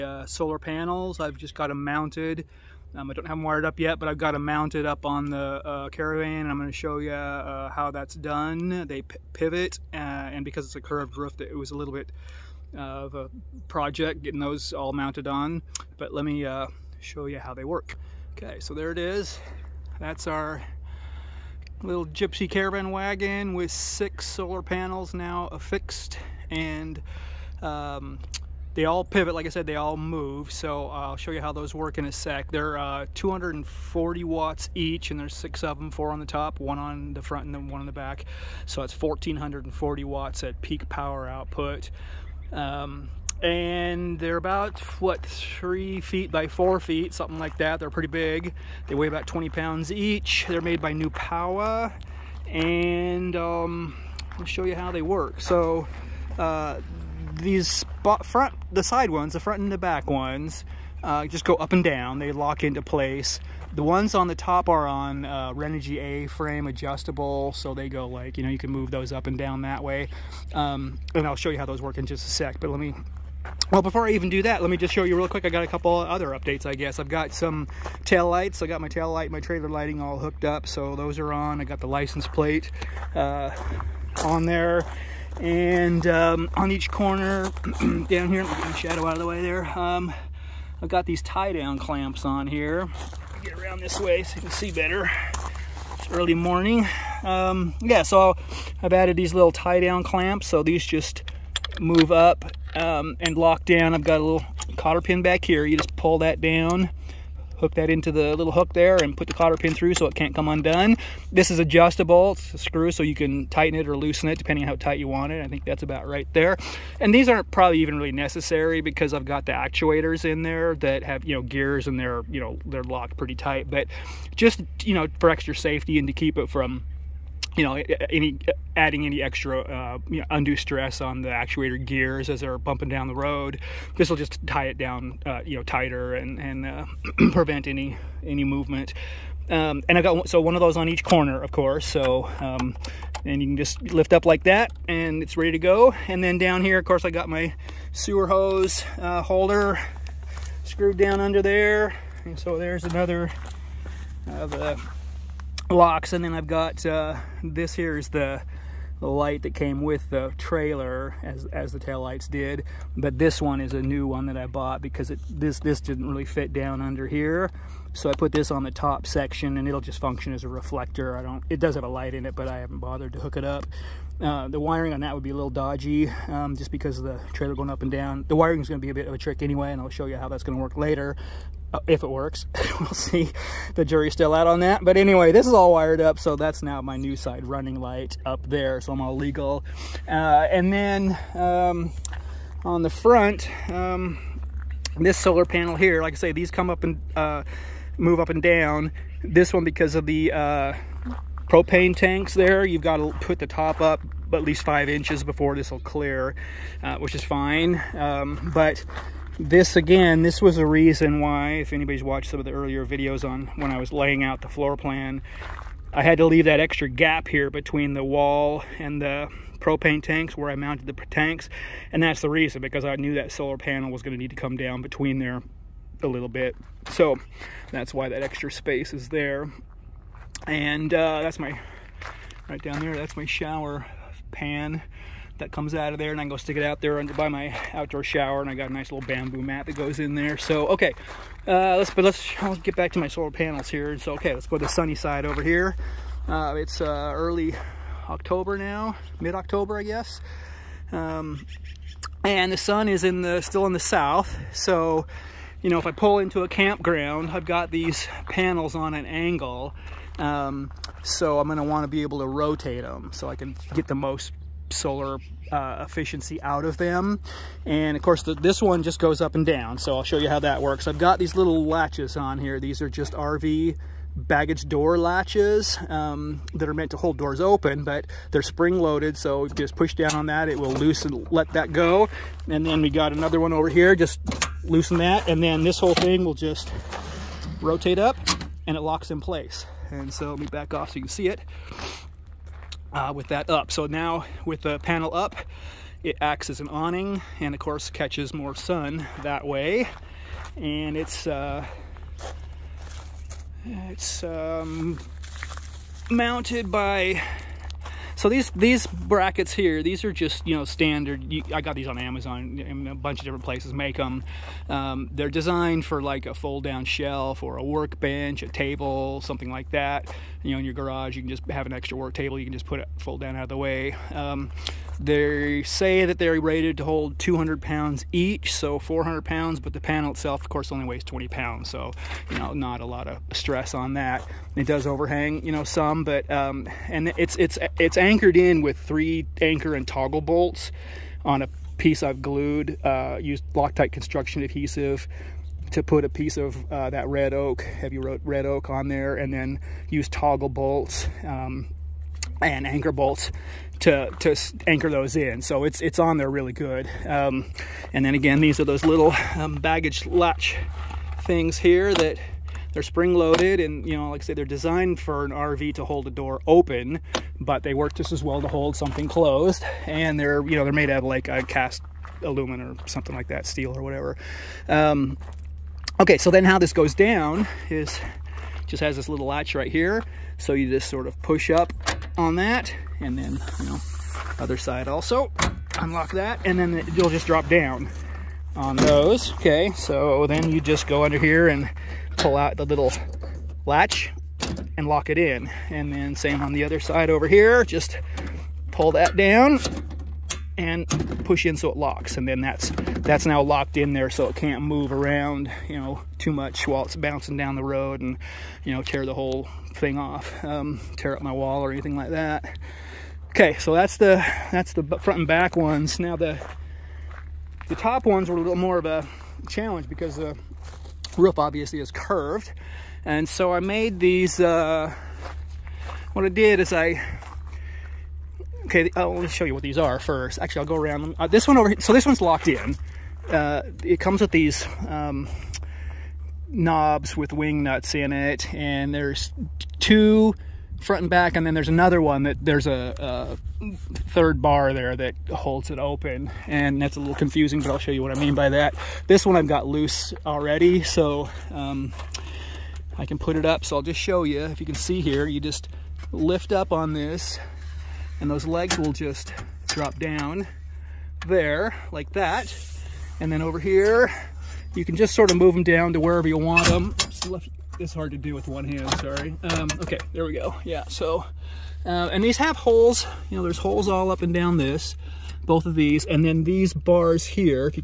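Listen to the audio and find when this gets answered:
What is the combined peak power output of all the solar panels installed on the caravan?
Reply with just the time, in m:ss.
0:38.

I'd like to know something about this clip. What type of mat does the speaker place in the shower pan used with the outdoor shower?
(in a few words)
bamboo mat.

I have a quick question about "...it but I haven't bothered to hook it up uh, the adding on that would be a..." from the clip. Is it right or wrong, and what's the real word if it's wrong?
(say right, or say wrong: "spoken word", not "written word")
wrong: "wiring", not "adding".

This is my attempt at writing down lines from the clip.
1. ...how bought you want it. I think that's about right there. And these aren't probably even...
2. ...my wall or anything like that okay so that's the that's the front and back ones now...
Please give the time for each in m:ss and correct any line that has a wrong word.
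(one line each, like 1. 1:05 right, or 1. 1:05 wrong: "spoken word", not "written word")
1. 1:54 wrong: "tight", not "bought"
2. 6:51 right.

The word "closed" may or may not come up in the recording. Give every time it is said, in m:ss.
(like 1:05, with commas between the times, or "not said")
6:09.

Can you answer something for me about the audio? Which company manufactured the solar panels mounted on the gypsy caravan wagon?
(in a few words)
Newpowa.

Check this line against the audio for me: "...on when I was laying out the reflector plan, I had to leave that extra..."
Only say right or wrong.
wrong.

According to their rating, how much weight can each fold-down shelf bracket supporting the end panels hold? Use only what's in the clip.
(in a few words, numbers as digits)
200 pounds.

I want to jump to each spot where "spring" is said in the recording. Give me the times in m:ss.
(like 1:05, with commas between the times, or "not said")
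4:38, 6:02.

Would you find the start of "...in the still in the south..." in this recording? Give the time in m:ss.
4:13.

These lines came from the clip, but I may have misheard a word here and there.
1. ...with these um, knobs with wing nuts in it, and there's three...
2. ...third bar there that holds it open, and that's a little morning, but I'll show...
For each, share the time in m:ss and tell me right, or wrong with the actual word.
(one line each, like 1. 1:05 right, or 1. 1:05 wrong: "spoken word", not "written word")
1. 7:14 wrong: "two", not "three"
2. 7:24 wrong: "confusing", not "morning".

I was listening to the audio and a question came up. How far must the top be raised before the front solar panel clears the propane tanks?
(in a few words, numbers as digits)
5 inches.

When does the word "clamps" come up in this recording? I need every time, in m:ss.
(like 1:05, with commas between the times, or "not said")
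1:31, 1:40.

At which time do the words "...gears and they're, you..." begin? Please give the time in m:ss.
2:01.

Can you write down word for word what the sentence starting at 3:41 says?
And that's the reason, because I knew that solar panel was gonna need to come down between there a little bit.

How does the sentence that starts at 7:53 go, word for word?
You know, there's holes all up and down this, both of these.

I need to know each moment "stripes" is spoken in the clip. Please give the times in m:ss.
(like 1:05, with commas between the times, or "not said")
not said.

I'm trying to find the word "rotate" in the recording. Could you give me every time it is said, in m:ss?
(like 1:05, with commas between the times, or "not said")
4:22, 4:47.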